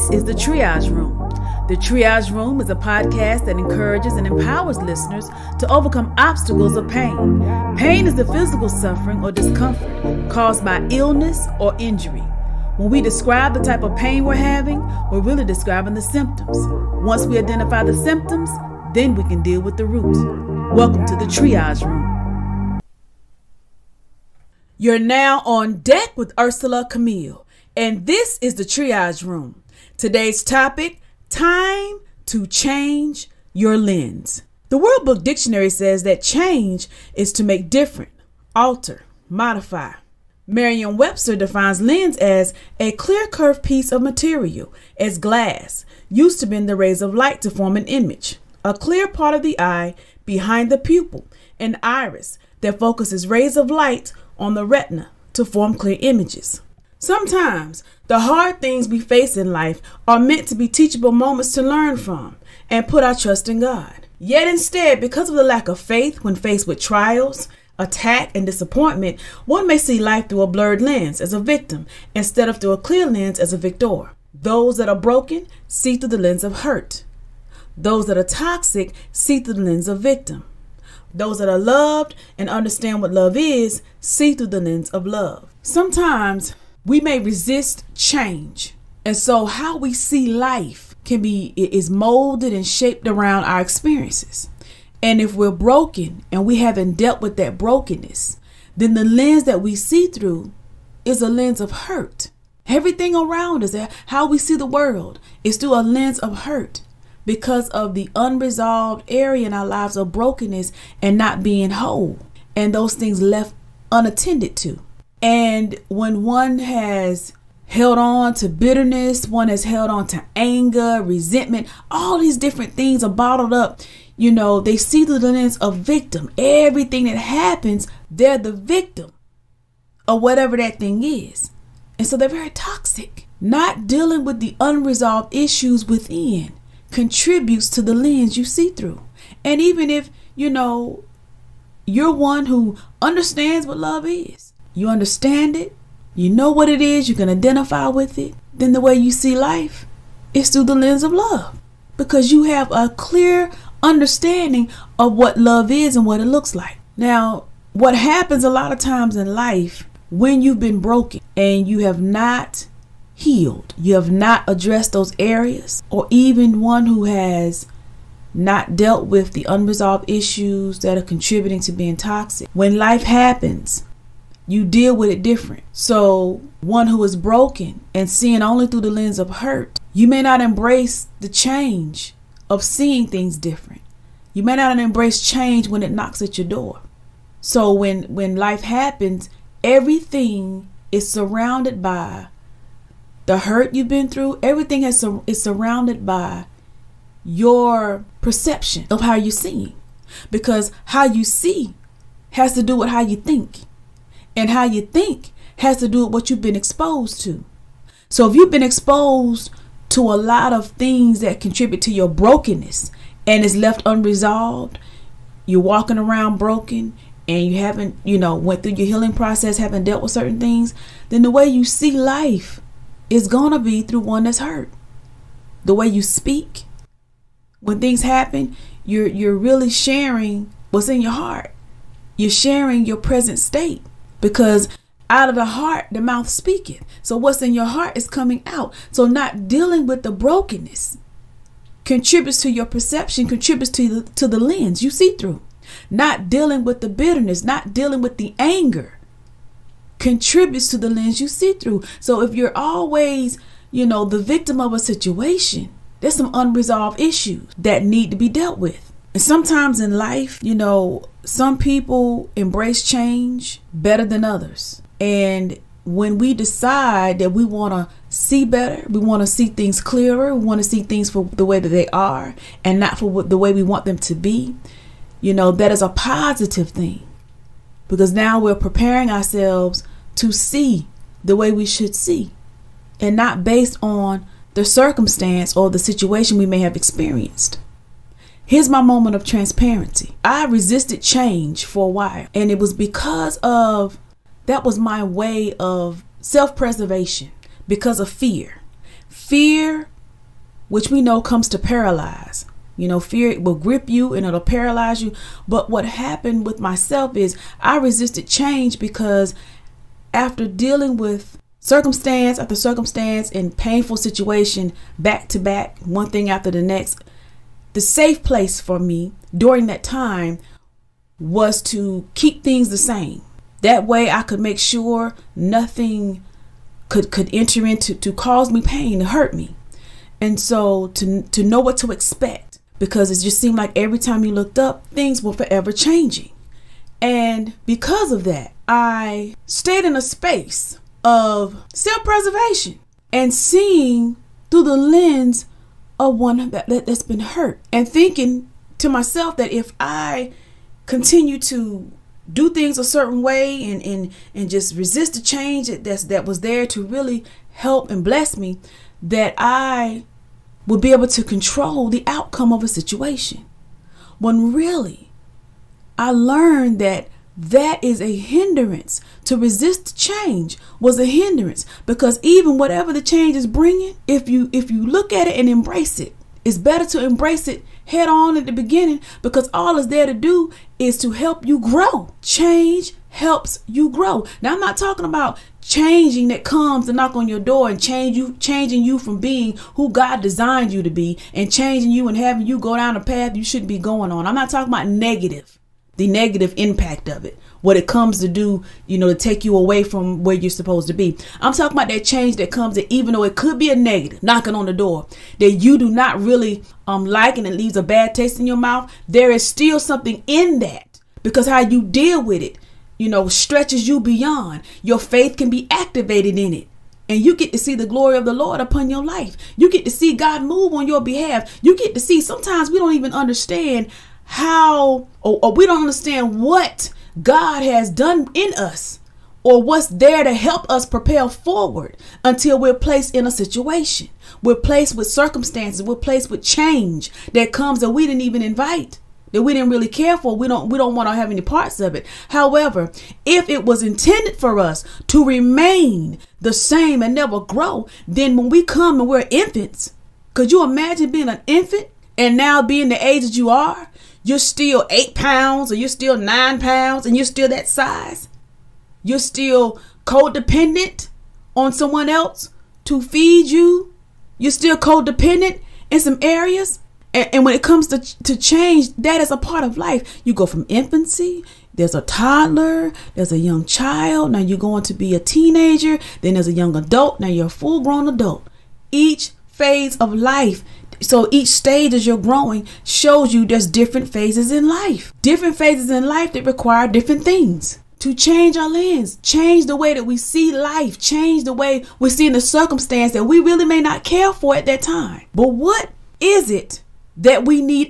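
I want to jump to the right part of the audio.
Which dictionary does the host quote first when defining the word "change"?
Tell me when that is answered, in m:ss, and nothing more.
0:34.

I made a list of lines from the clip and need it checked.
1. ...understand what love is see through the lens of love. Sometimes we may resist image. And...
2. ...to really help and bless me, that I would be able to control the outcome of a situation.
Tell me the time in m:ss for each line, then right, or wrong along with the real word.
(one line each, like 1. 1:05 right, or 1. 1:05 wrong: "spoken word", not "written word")
1. 1:22 wrong: "change", not "image"
2. 5:56 right.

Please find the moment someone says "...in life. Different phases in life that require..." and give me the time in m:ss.
8:04.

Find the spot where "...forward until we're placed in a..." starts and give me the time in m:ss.
7:11.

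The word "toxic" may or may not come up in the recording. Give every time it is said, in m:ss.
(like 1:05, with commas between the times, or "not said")
1:18, 2:12, 2:51.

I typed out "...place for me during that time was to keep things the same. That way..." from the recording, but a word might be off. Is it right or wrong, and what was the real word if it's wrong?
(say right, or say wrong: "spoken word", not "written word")
right.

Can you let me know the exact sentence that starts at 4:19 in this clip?
And sometimes in life, you know, some people embrace change better than others.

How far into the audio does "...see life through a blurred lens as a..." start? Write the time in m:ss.
1:09.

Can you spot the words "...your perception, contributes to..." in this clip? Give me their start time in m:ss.
4:02.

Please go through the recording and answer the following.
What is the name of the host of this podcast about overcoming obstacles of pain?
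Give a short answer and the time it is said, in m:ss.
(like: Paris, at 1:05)
Ursela Camille, at 0:26.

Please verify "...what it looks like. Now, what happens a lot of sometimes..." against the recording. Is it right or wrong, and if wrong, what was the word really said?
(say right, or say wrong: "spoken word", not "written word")
wrong: "times", not "sometimes".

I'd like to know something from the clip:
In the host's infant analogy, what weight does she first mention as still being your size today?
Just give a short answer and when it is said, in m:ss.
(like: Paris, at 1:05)
8 pounds, at 7:34.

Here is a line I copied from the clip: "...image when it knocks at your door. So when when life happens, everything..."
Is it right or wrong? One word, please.
wrong.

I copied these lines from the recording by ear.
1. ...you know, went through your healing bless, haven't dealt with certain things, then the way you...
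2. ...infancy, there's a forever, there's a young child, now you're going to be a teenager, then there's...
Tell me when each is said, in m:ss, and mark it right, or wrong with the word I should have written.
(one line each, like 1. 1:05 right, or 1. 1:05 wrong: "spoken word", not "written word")
1. 3:38 wrong: "process", not "bless"
2. 7:50 wrong: "toddler", not "forever".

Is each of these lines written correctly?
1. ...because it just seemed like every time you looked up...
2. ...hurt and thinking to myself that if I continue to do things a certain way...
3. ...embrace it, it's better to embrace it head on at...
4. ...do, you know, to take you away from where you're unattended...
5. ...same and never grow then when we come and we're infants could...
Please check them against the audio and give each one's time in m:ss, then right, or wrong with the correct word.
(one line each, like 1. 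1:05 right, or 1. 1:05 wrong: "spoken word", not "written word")
1. 5:32 right
2. 5:47 right
3. 6:15 right
4. 6:38 wrong: "supposed", not "unattended"
5. 7:26 right.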